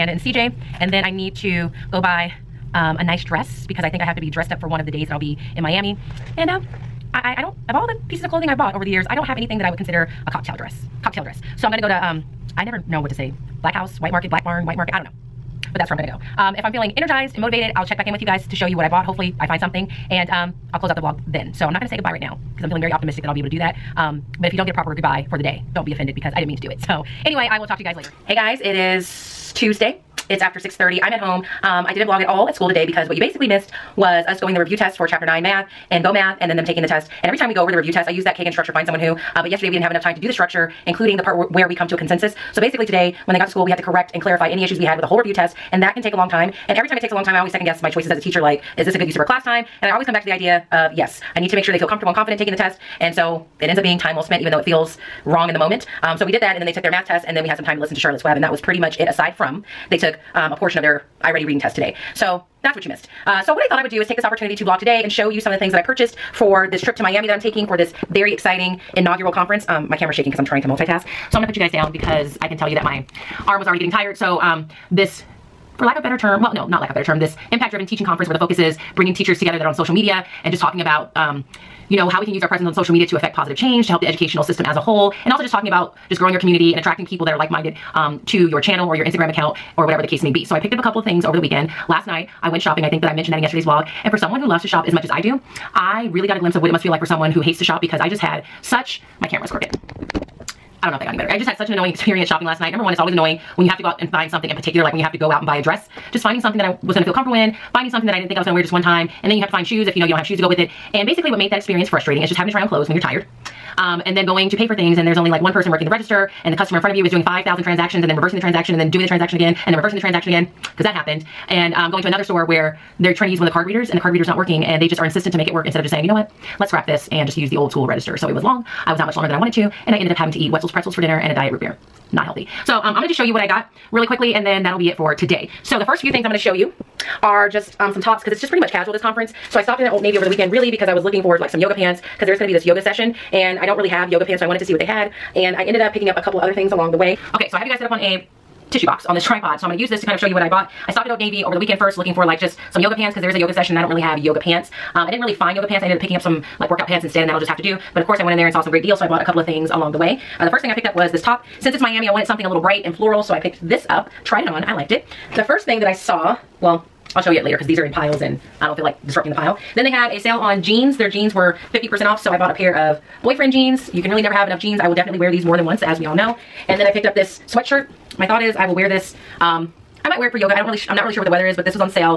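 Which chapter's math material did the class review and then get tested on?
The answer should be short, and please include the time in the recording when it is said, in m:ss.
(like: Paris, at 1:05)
9, at 0:35.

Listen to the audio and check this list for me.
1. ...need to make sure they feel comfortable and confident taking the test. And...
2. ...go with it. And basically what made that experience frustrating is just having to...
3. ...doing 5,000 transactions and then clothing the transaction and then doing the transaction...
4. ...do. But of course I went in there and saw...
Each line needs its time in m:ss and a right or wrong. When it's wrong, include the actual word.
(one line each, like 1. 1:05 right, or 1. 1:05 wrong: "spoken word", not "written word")
1. 0:51 right
2. 1:50 right
3. 1:57 wrong: "reversing", not "clothing"
4. 2:37 right.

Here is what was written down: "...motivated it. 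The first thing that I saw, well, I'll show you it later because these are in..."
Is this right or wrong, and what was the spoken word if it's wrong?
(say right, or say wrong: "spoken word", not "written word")
wrong: "liked", not "motivated".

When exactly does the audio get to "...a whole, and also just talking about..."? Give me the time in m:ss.
1:24.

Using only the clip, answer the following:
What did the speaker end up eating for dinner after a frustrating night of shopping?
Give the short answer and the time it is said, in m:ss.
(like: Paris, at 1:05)
Wetzel's pretzels, at 2:10.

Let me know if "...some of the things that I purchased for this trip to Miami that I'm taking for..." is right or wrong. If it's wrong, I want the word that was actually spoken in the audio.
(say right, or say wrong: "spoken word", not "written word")
right.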